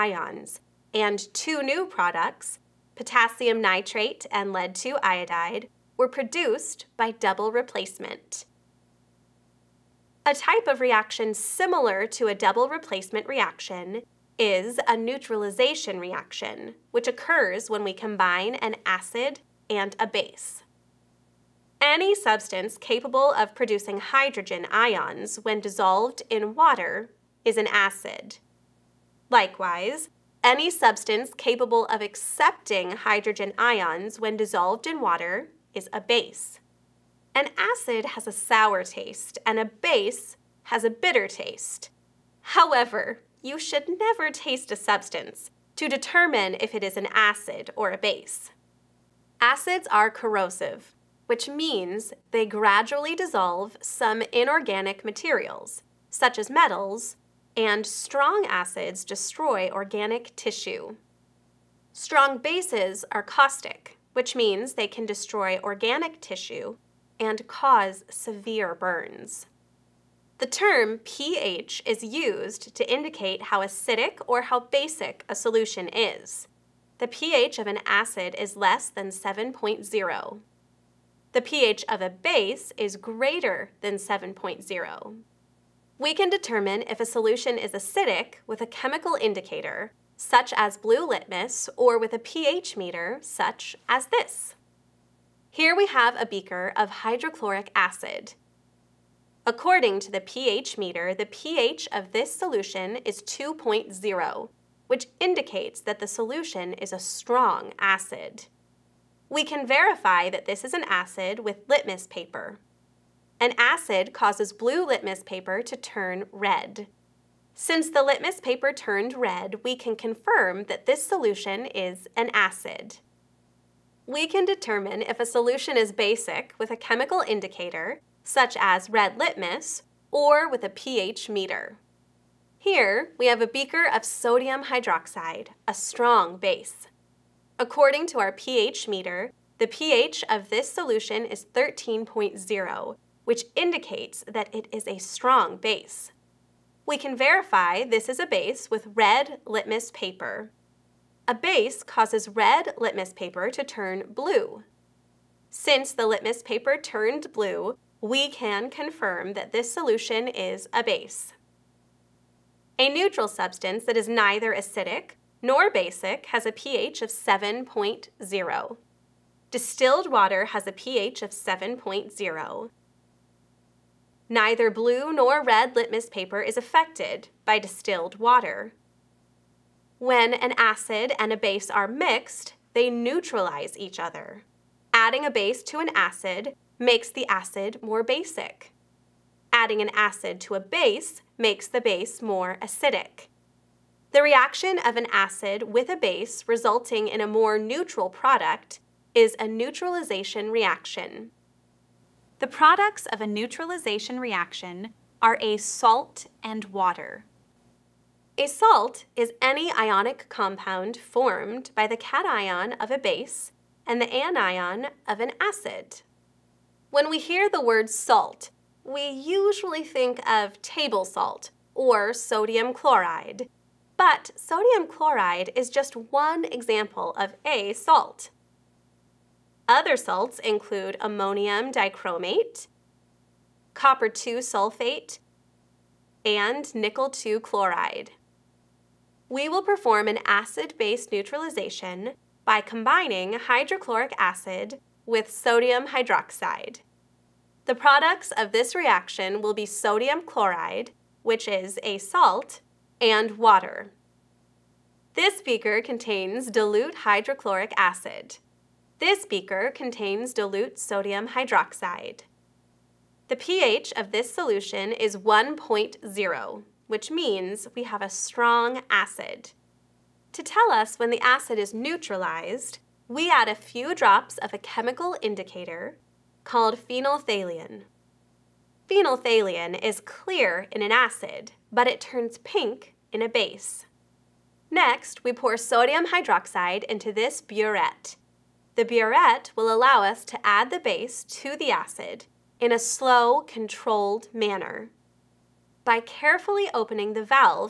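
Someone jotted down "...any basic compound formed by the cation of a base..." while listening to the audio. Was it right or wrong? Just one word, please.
wrong.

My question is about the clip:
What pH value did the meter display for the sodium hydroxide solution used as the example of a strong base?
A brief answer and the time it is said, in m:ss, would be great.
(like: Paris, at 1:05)
13.0, at 2:21.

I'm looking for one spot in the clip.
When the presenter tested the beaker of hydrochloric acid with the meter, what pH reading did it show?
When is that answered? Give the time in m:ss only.
1:43.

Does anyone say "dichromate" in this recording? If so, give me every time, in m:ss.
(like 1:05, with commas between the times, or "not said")
3:51.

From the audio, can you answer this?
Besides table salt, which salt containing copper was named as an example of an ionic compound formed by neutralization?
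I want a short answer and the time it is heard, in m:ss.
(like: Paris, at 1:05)
copper 2 sulfate, at 3:53.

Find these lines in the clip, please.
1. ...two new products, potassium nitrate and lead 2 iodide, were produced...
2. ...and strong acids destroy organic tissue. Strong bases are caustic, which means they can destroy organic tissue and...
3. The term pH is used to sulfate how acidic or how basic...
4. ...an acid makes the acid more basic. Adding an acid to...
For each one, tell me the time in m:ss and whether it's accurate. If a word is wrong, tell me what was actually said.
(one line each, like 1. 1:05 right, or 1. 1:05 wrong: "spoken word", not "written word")
1. 0:01 right
2. 0:57 right
3. 1:10 wrong: "indicate", not "sulfate"
4. 3:05 right.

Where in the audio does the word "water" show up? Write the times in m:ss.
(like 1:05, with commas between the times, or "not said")
0:26, 0:35, 2:50, 2:58, 3:26, 4:13.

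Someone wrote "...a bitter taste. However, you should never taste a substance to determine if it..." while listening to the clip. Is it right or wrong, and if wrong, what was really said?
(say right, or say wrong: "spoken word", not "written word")
right.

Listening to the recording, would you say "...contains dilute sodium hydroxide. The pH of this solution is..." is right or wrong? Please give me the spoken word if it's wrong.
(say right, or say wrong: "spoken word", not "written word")
right.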